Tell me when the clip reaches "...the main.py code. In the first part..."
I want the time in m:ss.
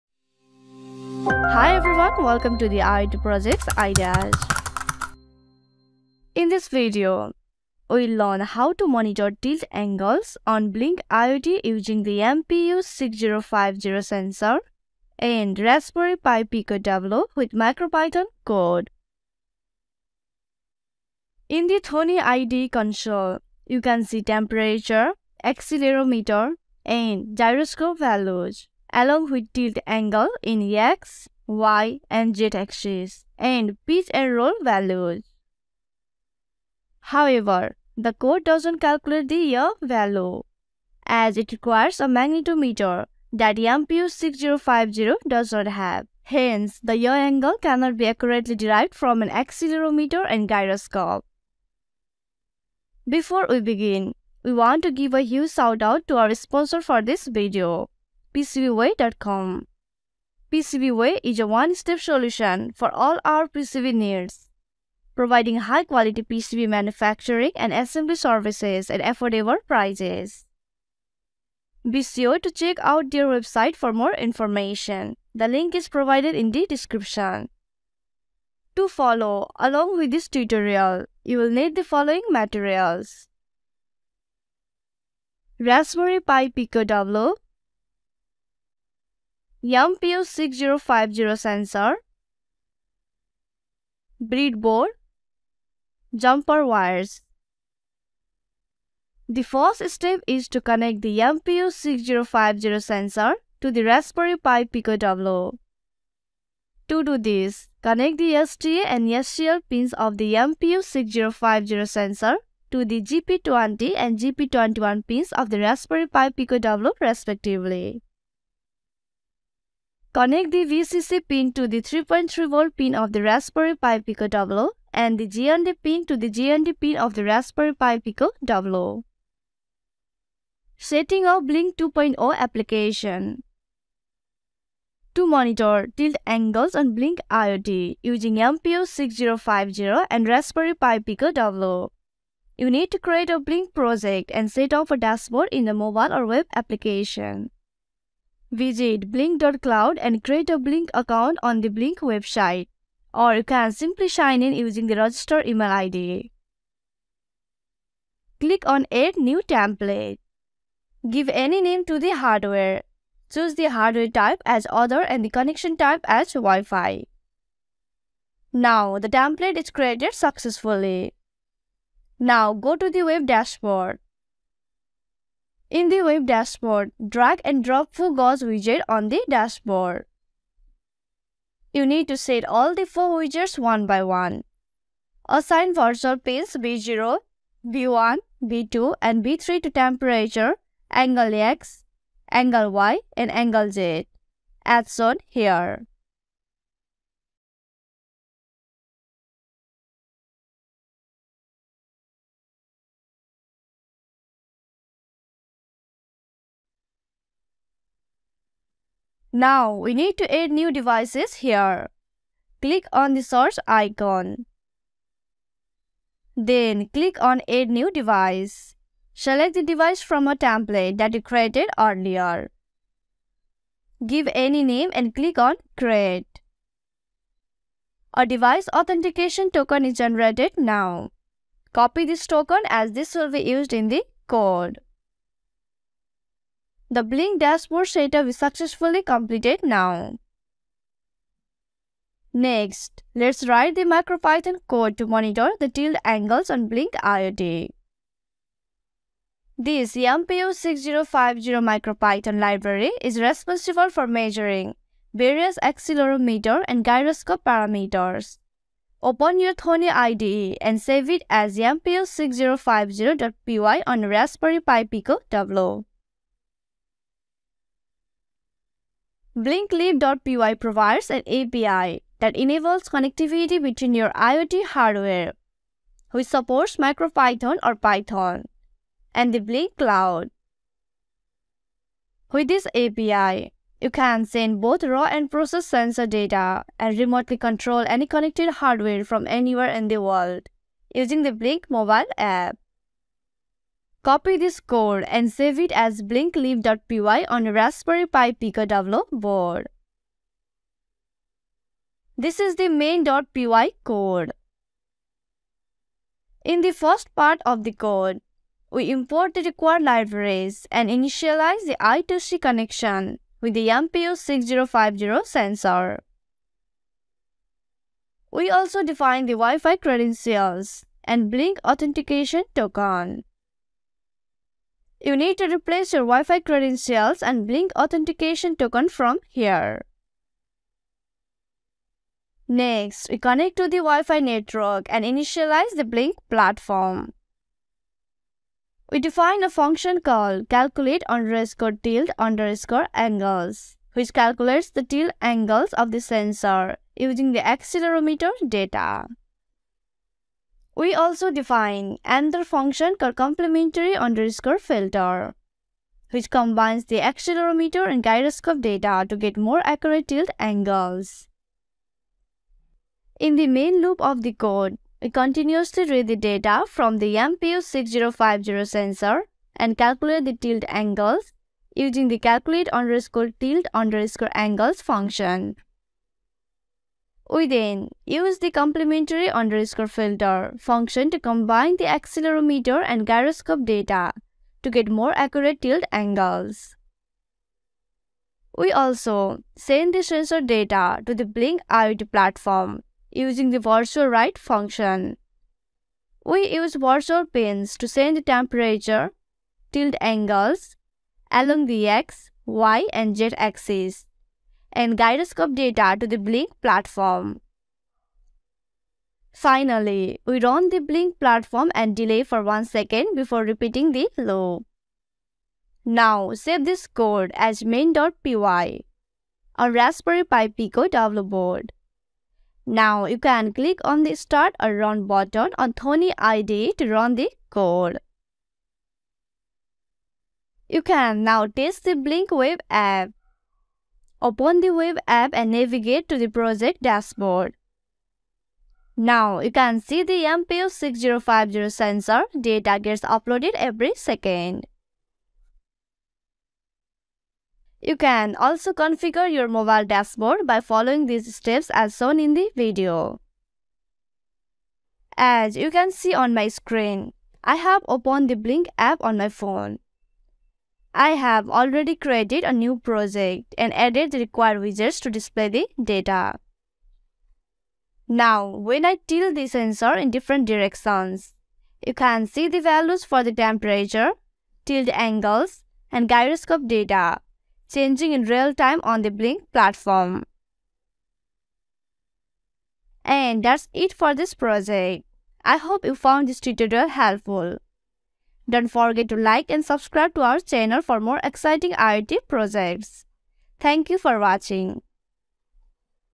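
5:02.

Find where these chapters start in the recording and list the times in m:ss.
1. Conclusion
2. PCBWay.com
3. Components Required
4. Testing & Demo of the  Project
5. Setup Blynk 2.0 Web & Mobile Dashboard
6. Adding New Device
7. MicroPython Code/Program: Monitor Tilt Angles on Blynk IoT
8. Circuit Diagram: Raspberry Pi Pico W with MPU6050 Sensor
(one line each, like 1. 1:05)
1. 8:00
2. 0:55
3. 1:20
4. 7:10
5. 2:10
6. 3:30
7. 4:01
8. 1:40.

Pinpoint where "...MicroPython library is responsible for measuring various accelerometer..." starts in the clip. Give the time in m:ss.
4:11.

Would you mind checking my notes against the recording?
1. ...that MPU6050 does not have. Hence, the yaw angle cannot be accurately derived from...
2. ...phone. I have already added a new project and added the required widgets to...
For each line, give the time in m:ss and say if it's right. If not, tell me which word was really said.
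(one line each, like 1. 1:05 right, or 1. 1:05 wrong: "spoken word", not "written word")
1. 0:43 right
2. 7:39 wrong: "created", not "added".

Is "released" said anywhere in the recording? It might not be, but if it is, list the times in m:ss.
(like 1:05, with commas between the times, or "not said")
not said.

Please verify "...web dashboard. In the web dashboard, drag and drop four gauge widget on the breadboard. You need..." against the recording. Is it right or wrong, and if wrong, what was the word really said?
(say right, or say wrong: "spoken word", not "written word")
wrong: "dashboard", not "breadboard".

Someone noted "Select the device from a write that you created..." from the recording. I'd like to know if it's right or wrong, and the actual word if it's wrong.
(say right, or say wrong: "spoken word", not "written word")
wrong: "template", not "write".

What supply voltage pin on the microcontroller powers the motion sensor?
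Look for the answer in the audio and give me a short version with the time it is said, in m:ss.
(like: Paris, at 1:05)
3.3 volt, at 2:01.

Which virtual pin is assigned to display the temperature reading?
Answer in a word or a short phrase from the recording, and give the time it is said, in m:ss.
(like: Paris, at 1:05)
V0, at 3:06.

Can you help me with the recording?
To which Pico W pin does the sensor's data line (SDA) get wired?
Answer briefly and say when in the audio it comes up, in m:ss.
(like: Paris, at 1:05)
GP20, at 1:52.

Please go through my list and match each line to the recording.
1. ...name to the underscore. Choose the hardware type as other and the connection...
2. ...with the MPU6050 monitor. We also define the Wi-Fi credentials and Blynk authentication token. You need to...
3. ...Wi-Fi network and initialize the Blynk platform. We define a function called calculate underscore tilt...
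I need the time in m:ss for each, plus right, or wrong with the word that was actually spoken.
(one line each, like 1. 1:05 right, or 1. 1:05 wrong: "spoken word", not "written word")
1. 2:41 wrong: "hardware", not "underscore"
2. 5:13 wrong: "sensor", not "monitor"
3. 5:33 right.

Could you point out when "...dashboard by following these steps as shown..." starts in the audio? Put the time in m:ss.
7:29.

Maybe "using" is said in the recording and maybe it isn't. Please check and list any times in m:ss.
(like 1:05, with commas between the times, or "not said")
0:11, 2:18, 2:34, 4:50, 5:46, 6:11, 6:33.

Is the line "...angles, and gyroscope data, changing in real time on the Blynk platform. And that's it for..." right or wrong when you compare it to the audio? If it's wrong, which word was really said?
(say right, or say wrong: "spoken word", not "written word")
right.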